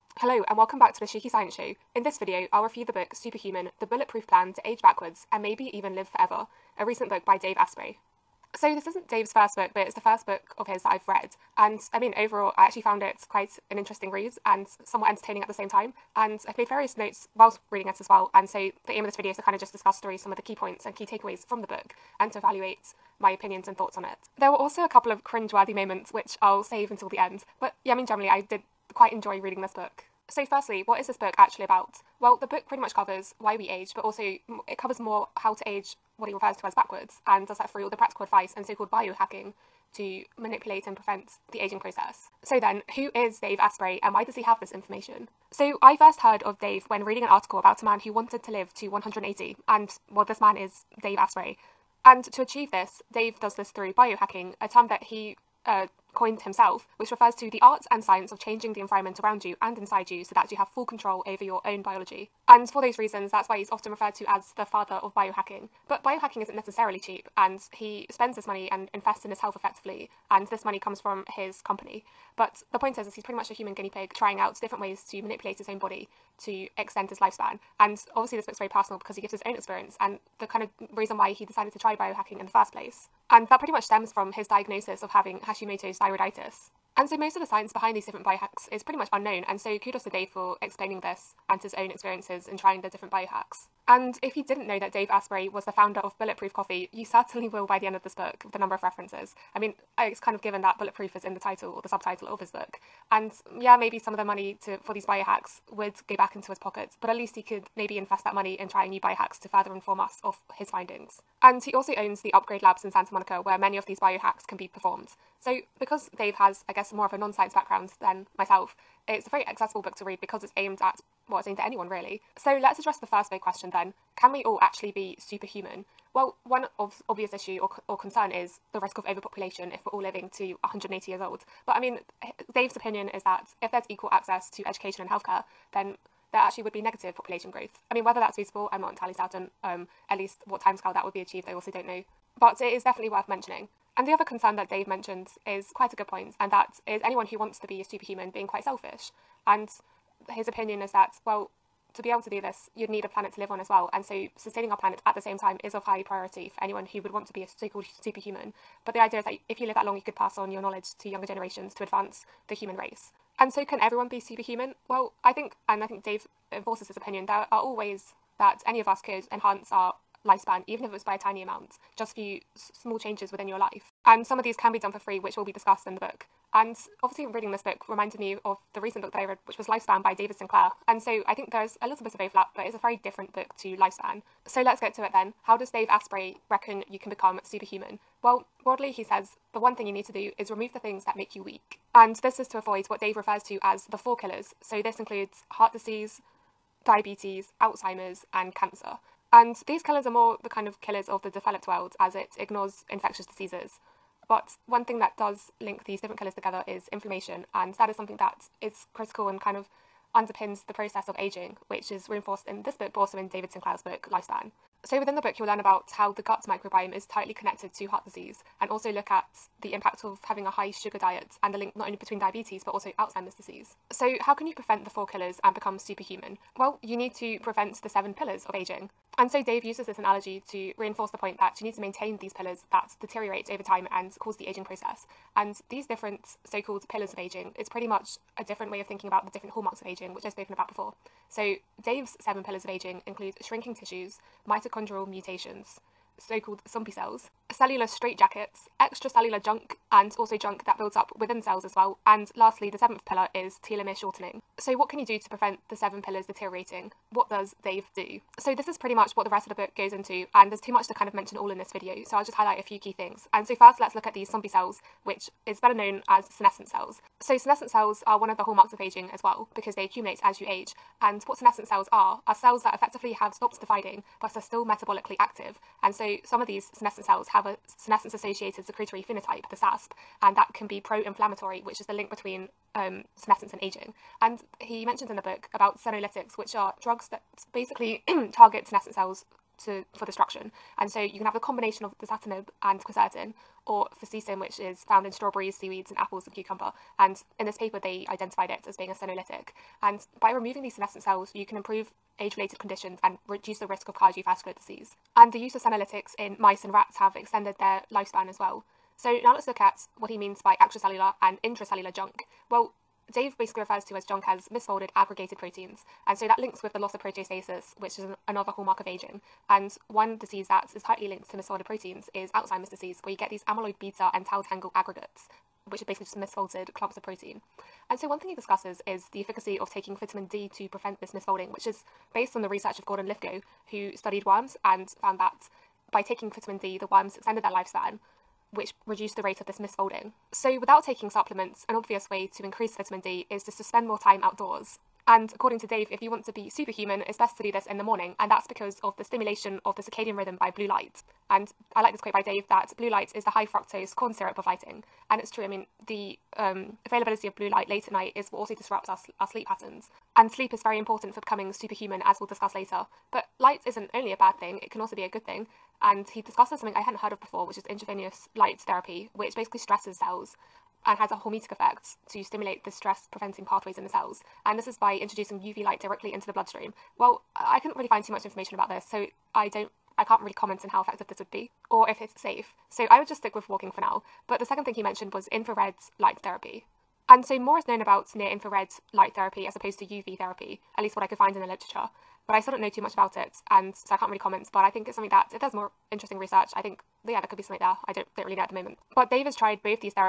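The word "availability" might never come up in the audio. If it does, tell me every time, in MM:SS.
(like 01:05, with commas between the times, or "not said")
05:56.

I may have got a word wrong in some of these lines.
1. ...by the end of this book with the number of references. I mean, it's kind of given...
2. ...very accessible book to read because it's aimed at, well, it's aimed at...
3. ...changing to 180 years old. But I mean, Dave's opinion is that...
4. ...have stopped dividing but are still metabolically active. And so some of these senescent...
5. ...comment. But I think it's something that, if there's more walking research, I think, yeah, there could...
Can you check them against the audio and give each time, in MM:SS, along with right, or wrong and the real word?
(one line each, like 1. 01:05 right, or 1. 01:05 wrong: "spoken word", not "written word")
1. 01:37 right
2. 01:59 right
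3. 02:10 wrong: "living", not "changing"
4. 04:33 right
5. 06:34 wrong: "interesting", not "walking".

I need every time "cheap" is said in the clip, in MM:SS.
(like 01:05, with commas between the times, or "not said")
01:06.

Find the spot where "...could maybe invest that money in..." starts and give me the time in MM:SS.
01:47.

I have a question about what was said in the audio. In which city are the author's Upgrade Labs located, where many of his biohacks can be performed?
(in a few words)
Santa Monica.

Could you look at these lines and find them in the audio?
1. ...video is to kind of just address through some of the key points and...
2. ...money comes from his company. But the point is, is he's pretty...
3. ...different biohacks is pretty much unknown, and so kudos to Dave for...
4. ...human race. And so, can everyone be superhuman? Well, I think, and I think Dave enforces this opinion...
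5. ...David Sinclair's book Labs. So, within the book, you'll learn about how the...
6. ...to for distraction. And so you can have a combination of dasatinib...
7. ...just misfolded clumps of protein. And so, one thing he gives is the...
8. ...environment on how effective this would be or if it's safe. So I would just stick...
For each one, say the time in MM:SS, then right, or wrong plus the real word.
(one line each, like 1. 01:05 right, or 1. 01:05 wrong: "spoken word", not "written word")
1. 00:19 wrong: "discuss", not "address"
2. 01:10 right
3. 01:28 right
4. 02:42 right
5. 03:33 wrong: "Lifespan", not "Labs"
6. 04:49 right
7. 05:26 wrong: "discusses", not "gives"
8. 06:20 wrong: "comment", not "environment".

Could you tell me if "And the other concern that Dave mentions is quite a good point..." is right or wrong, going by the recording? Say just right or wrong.
right.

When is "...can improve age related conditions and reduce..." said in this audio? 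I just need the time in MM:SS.
05:01.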